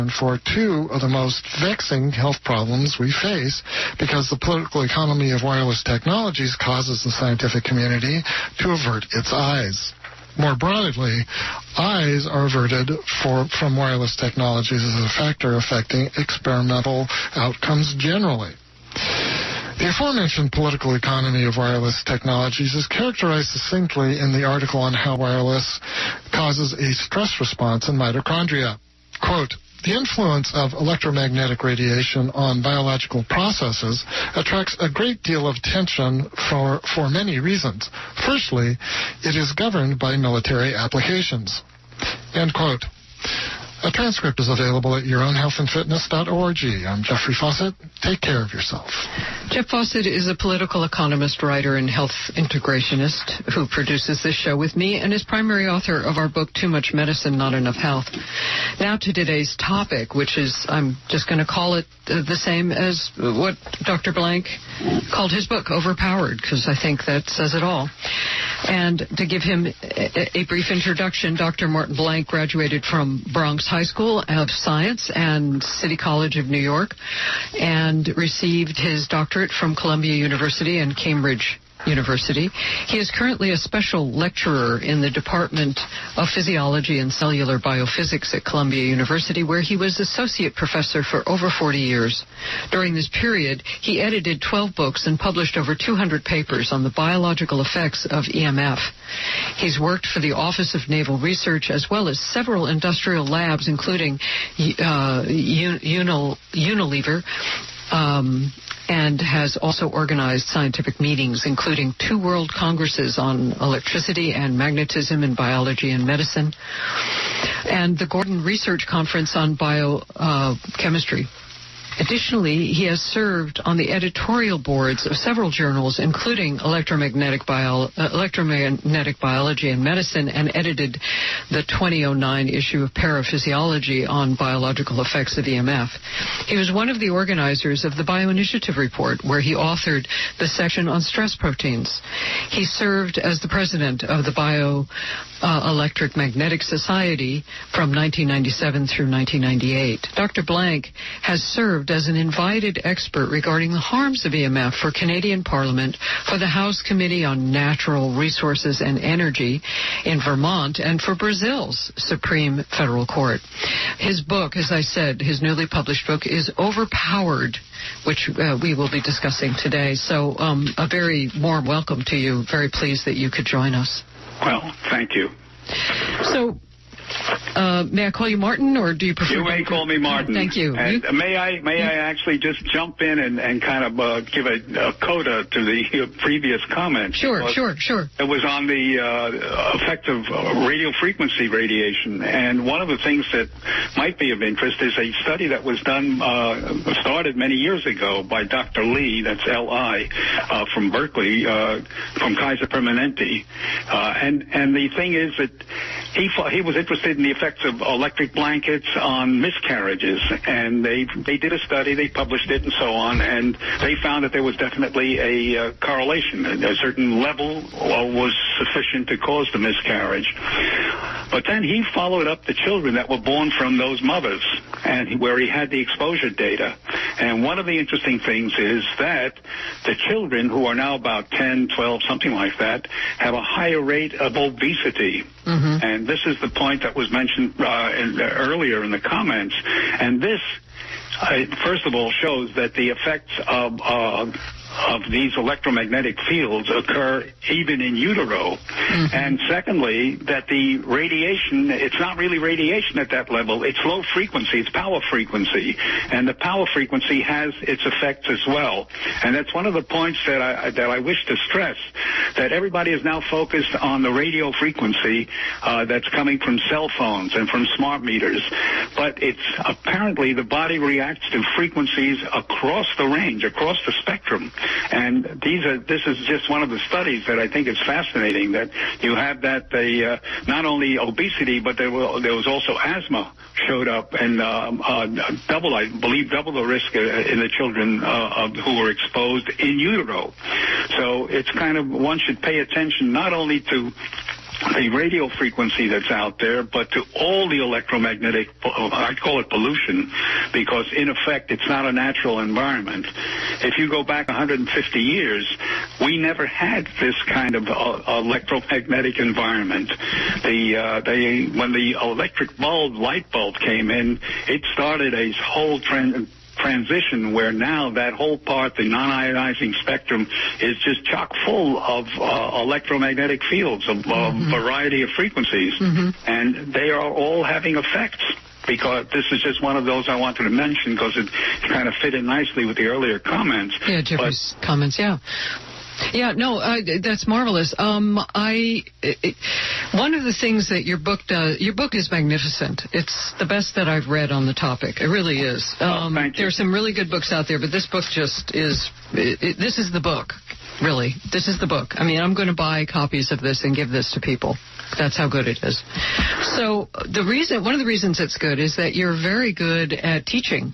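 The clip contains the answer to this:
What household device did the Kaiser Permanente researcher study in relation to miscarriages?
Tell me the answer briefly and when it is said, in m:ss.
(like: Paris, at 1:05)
Electric blankets, at 3:27.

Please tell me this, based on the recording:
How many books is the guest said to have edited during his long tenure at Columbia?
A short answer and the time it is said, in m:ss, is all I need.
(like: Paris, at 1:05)
12, at 1:34.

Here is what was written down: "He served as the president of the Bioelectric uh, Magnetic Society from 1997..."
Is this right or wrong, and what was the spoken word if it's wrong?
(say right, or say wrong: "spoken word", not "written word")
right.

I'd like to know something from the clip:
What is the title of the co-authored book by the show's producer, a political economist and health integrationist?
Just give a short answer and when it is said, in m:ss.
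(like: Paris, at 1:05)
Too Much Medicine, Not Enough Health, at 0:56.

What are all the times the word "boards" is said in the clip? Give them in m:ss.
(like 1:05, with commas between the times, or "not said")
2:04.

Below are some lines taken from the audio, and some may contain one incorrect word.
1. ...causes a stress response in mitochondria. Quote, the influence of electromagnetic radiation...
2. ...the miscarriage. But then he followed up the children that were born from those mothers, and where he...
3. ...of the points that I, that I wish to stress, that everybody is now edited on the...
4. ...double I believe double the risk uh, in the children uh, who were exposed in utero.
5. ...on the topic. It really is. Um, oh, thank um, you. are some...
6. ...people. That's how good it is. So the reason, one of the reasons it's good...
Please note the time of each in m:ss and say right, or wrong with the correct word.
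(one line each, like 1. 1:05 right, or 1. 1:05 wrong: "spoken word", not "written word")
1. 0:26 right
2. 3:39 right
3. 4:19 wrong: "focused", not "edited"
4. 4:45 right
5. 5:44 right
6. 5:54 right.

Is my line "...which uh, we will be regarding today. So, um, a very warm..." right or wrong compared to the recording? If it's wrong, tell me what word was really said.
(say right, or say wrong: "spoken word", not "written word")
wrong: "discussing", not "regarding".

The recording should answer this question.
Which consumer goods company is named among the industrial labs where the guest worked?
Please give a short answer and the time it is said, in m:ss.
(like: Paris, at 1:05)
Unilever, at 1:45.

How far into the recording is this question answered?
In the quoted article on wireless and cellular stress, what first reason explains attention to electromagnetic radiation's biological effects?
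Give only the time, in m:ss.
0:40.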